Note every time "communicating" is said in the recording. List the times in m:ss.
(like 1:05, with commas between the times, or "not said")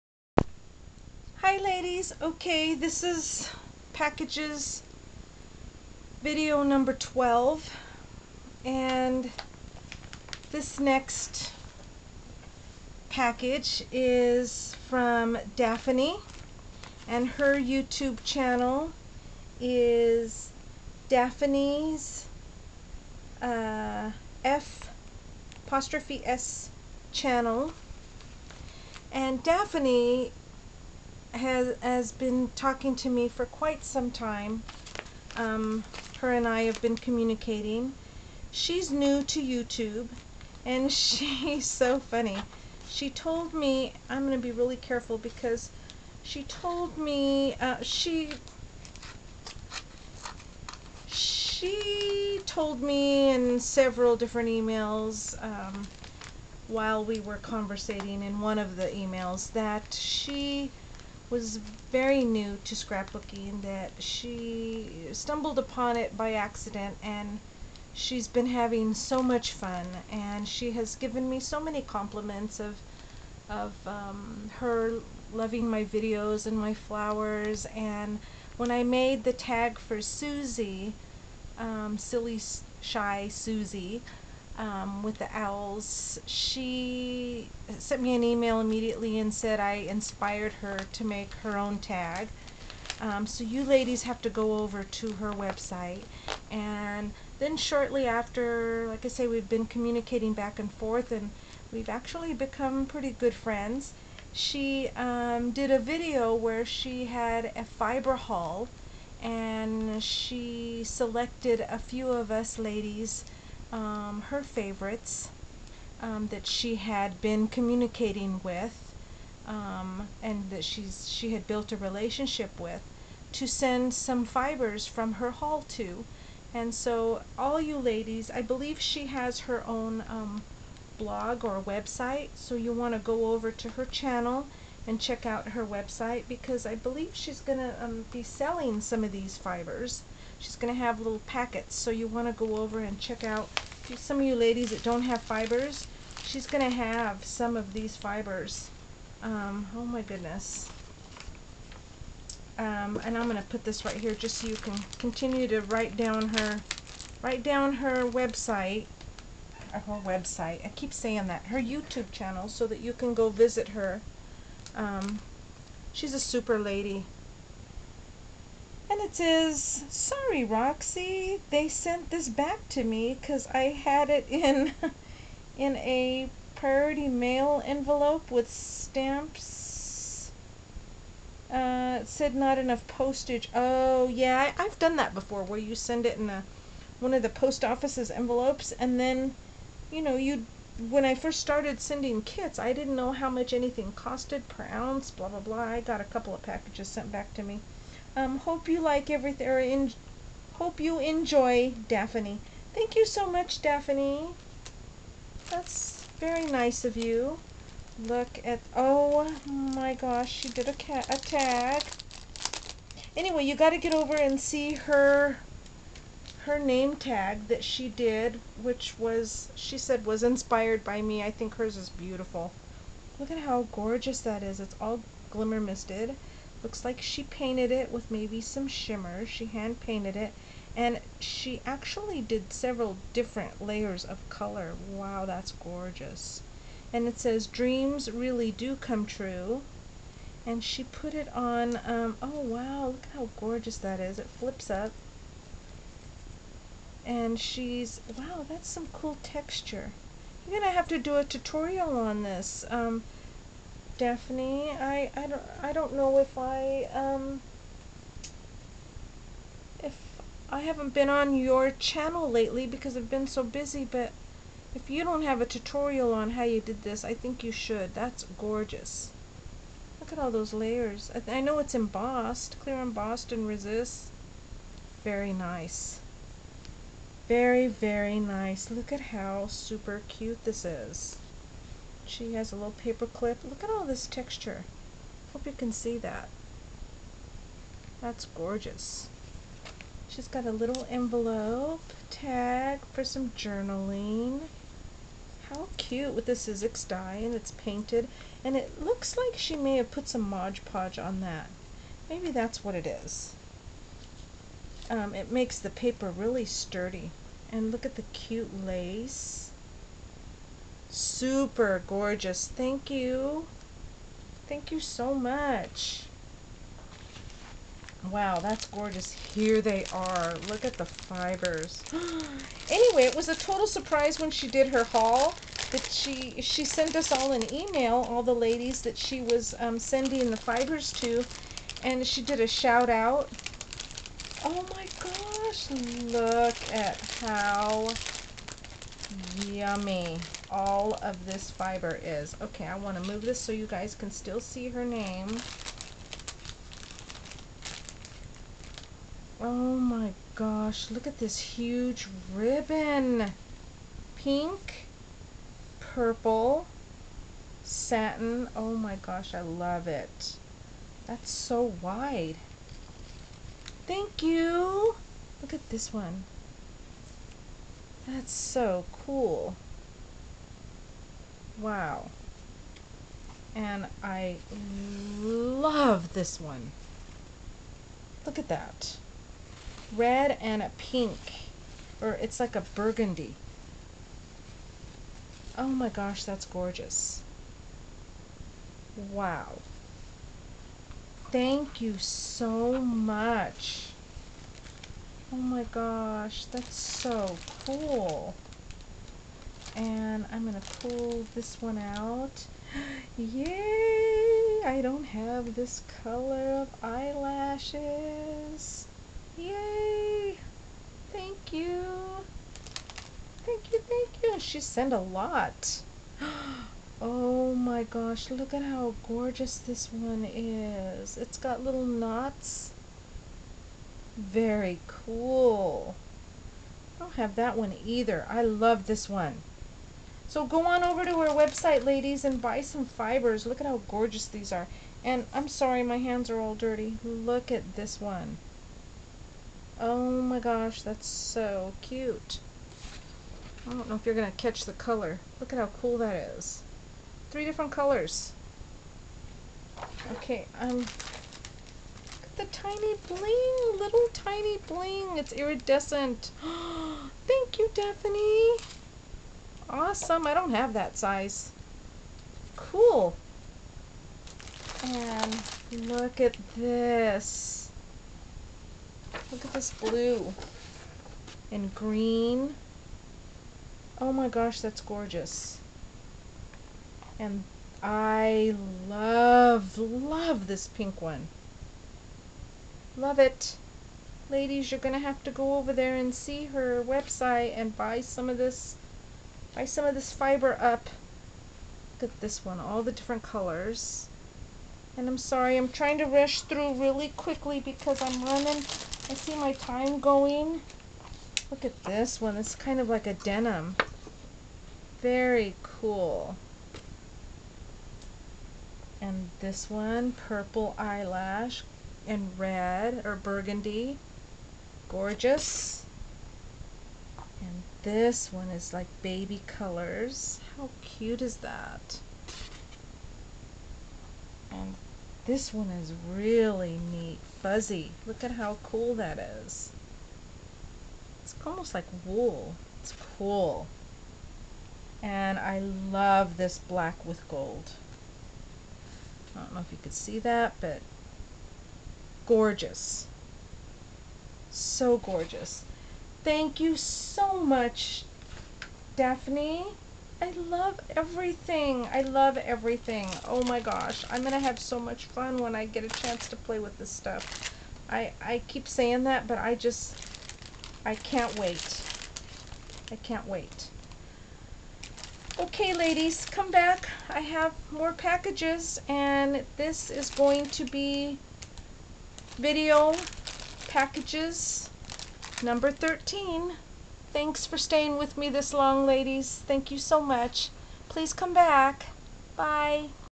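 0:36, 1:39, 1:57.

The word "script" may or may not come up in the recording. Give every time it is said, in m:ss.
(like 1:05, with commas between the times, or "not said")
not said.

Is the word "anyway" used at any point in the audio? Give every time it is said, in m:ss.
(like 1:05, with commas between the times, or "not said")
3:33, 5:22.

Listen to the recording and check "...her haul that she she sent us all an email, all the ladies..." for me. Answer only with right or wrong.
right.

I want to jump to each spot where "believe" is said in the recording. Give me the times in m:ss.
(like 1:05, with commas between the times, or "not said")
2:08, 2:16.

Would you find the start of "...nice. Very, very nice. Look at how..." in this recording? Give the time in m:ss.
4:35.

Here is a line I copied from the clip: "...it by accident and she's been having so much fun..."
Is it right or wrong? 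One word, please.
right.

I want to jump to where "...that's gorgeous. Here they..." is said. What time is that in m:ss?
5:18.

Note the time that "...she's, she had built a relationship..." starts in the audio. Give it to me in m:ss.
2:00.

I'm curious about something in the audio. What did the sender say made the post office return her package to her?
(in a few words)
Not enough postage.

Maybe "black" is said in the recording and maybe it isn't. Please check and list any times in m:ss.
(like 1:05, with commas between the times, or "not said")
8:56.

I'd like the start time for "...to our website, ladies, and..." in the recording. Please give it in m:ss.
7:11.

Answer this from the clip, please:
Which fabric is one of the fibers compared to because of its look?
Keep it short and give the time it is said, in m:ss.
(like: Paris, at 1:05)
Denim, at 8:23.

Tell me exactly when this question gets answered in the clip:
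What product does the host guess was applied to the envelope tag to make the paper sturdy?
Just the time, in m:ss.
5:00.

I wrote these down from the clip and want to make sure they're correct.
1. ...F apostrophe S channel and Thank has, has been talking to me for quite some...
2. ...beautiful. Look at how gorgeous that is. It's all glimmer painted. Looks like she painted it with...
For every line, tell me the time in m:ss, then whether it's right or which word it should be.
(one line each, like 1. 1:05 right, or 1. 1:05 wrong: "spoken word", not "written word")
1. 0:24 wrong: "Daphanie", not "Thank"
2. 3:41 wrong: "misted", not "painted".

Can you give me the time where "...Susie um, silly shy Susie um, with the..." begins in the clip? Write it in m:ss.
1:20.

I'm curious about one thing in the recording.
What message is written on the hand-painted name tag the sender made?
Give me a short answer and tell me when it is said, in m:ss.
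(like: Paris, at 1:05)
Dreams really do come true, at 3:57.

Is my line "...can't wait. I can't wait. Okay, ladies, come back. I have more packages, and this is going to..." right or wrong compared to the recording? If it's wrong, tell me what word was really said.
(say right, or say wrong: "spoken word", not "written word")
right.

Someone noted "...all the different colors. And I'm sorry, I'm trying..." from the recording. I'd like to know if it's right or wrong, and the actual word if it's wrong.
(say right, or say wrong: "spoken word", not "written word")
right.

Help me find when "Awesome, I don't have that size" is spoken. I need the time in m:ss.
7:39.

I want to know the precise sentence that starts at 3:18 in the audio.
Um, hope you like everything, or in, hope you enjoy Daphanie.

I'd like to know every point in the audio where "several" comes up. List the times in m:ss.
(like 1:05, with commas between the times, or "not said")
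0:53, 3:52.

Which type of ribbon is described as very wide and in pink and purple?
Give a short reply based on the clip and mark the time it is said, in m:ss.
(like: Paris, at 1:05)
Satin, at 5:57.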